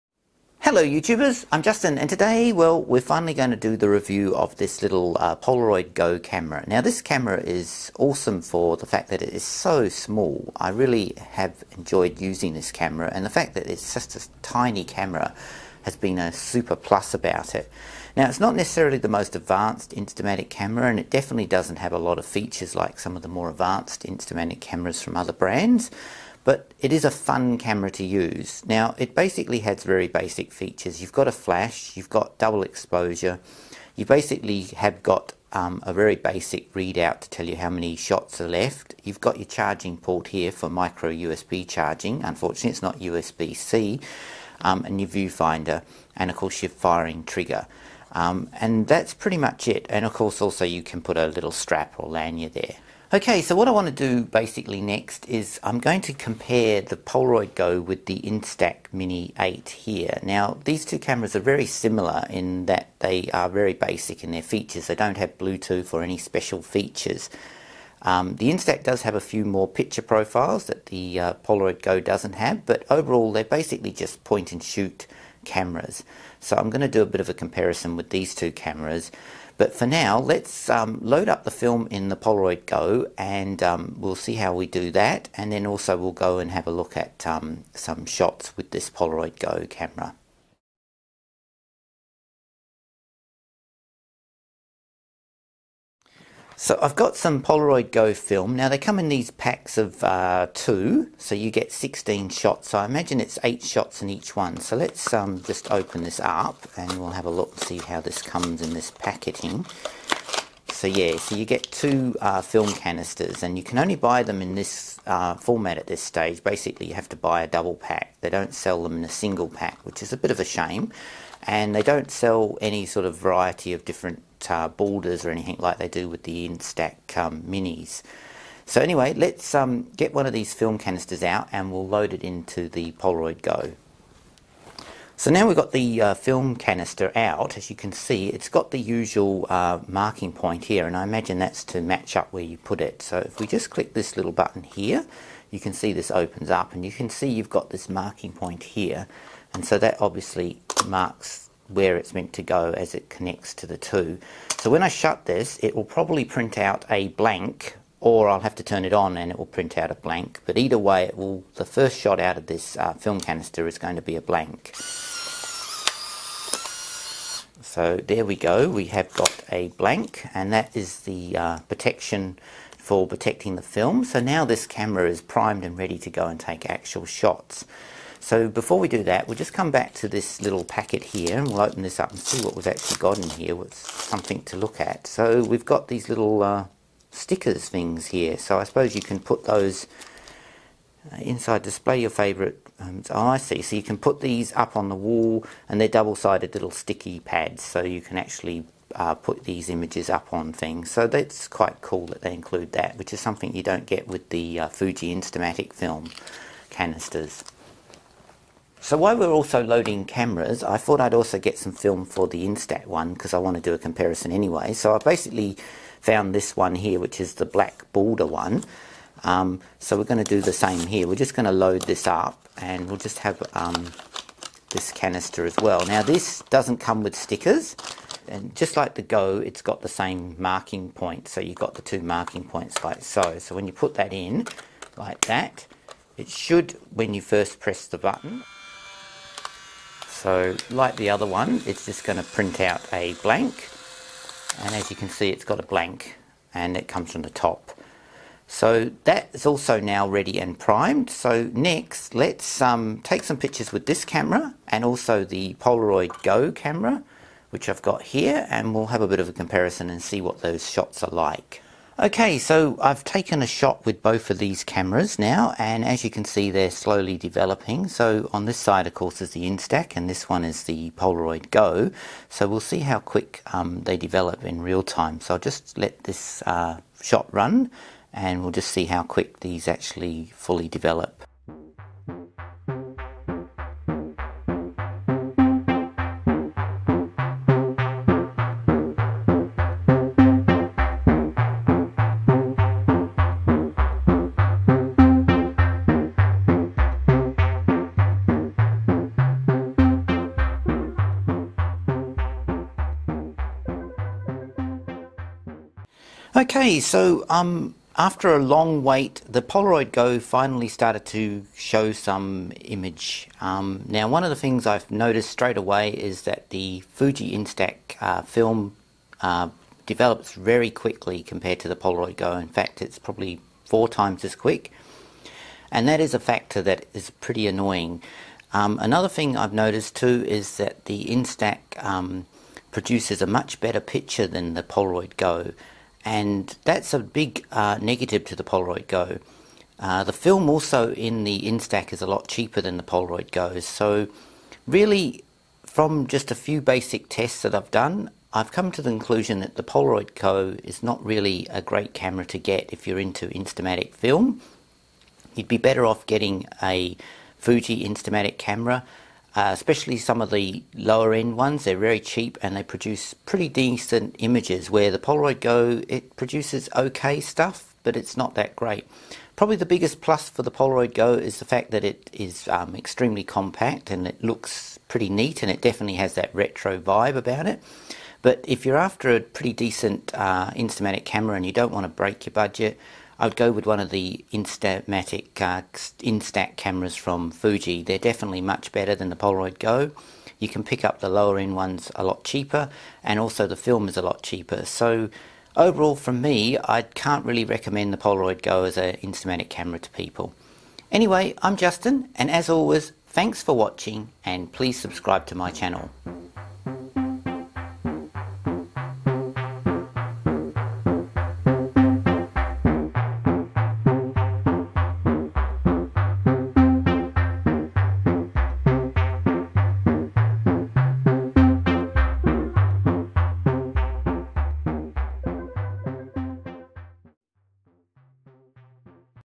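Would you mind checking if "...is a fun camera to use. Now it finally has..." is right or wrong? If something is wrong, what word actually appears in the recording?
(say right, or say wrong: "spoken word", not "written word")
wrong: "basically", not "finally".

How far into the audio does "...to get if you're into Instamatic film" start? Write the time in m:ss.
5:52.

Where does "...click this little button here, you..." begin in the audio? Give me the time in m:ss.
2:23.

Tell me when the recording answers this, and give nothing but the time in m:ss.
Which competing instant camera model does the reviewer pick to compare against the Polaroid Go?
0:58.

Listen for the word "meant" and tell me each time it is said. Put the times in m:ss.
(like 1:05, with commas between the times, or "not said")
2:32.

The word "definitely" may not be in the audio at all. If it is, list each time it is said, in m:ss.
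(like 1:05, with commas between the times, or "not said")
0:21, 6:15, 6:27.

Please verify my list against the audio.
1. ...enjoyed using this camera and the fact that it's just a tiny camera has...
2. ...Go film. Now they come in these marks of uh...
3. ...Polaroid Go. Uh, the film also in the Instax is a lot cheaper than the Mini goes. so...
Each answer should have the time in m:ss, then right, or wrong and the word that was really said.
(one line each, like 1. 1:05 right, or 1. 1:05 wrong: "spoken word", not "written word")
1. 0:11 right
2. 1:37 wrong: "packs", not "marks"
3. 5:38 wrong: "Polaroid", not "Mini".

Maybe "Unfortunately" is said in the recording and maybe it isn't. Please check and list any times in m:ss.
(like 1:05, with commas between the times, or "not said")
0:42.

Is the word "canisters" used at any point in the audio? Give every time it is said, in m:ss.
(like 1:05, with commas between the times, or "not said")
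1:52, 2:10, 2:16, 2:43, 3:26, 3:44.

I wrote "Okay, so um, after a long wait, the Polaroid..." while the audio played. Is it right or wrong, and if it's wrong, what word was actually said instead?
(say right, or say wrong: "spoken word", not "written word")
right.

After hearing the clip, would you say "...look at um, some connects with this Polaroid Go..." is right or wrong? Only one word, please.
wrong.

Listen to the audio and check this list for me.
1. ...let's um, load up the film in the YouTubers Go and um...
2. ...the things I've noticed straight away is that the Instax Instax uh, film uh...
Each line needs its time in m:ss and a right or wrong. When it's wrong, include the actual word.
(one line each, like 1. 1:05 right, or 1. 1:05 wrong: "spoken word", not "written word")
1. 1:20 wrong: "Polaroid", not "YouTubers"
2. 5:14 wrong: "Fuji", not "Instax".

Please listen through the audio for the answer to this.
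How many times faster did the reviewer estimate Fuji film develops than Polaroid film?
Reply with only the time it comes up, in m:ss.
5:23.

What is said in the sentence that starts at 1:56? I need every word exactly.
Basically you have to buy a double pack.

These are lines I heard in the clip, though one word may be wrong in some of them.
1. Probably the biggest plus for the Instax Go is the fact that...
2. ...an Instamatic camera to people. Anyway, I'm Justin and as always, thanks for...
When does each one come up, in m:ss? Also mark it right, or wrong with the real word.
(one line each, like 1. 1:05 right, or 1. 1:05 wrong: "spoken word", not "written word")
1. 6:09 wrong: "Polaroid", not "Instax"
2. 6:38 right.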